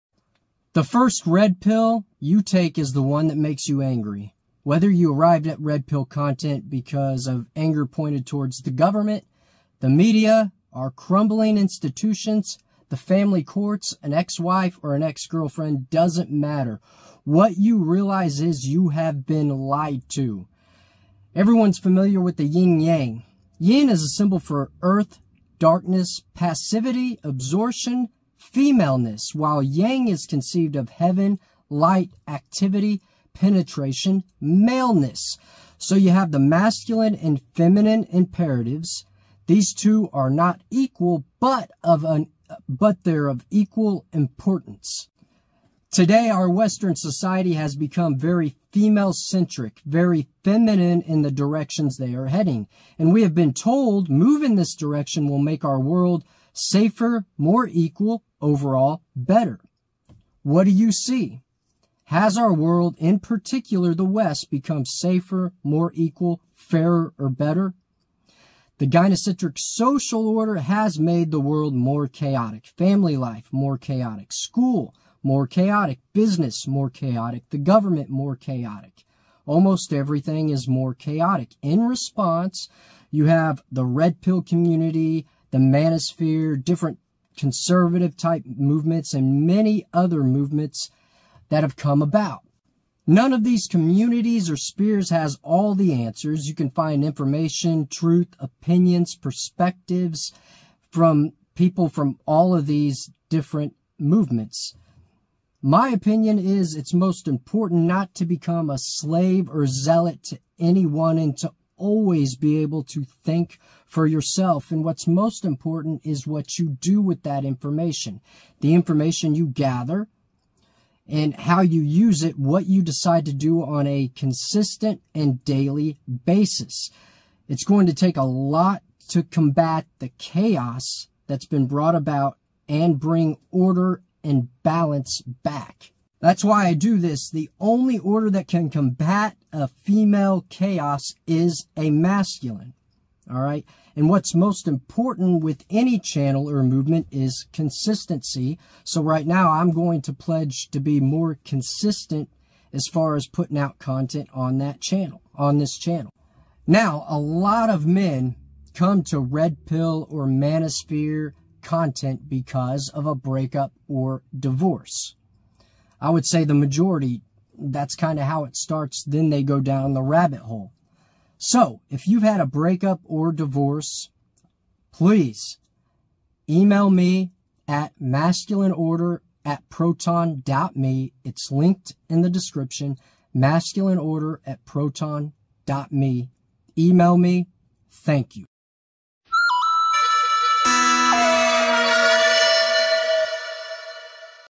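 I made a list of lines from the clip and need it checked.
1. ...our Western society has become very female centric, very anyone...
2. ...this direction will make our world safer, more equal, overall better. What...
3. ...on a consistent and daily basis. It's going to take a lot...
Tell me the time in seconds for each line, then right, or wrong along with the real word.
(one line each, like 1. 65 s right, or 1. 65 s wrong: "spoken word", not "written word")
1. 46 s wrong: "feminine", not "anyone"
2. 54 s right
3. 123 s right.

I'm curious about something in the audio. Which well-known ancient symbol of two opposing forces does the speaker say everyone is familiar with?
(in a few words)
yin yang.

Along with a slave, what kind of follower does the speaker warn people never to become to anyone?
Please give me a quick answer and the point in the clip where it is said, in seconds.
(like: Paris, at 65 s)
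zealot, at 109 s.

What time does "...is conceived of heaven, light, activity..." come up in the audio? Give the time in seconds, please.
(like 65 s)
30 s.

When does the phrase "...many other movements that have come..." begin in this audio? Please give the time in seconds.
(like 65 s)
89 s.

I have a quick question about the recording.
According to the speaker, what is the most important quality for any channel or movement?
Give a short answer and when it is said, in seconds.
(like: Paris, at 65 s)
consistency, at 147 s.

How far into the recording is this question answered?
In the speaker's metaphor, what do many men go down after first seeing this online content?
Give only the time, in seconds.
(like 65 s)
170 s.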